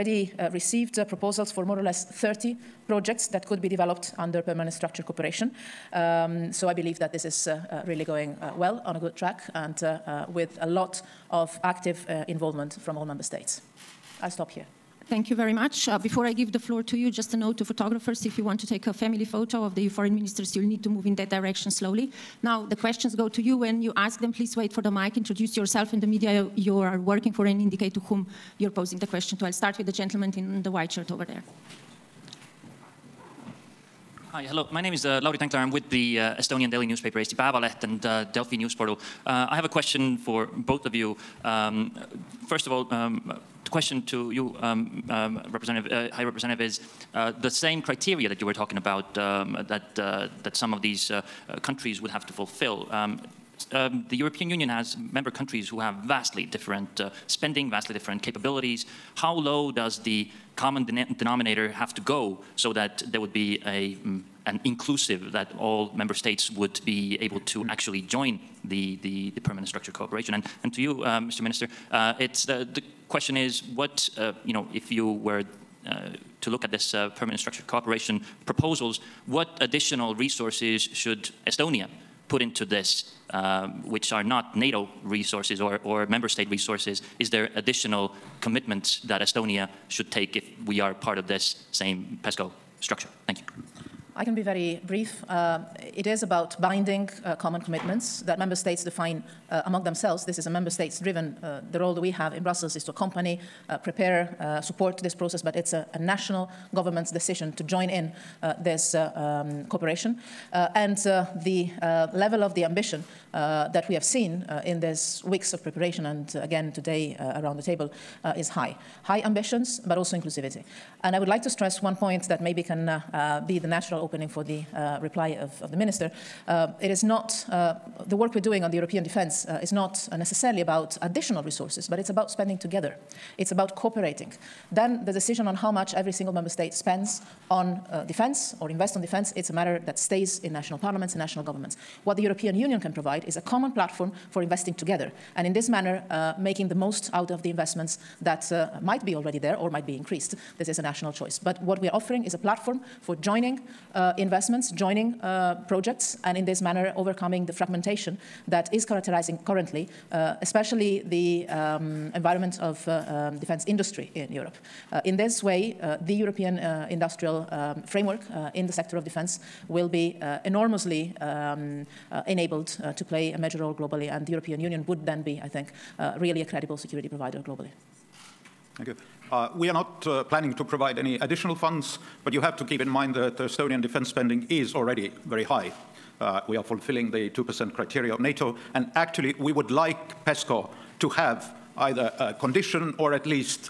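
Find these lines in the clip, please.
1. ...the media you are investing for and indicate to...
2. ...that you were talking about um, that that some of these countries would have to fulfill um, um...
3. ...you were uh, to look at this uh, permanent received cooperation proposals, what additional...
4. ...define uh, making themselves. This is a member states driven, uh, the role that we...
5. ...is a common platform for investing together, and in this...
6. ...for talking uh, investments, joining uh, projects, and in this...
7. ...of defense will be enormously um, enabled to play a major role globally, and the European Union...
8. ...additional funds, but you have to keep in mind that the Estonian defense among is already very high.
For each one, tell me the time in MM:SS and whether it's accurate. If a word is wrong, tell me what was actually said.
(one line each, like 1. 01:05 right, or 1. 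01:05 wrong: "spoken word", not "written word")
1. 00:26 wrong: "working", not "investing"
2. 00:48 right
3. 01:14 wrong: "structured", not "received"
4. 01:38 wrong: "among", not "making"
5. 02:23 right
6. 02:33 wrong: "joining", not "talking"
7. 02:48 right
8. 03:01 wrong: "spending", not "among".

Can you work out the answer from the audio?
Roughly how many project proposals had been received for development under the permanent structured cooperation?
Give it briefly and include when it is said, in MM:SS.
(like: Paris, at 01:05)
30, at 00:02.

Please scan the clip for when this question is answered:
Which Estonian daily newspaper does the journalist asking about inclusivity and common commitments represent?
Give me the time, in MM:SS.
00:37.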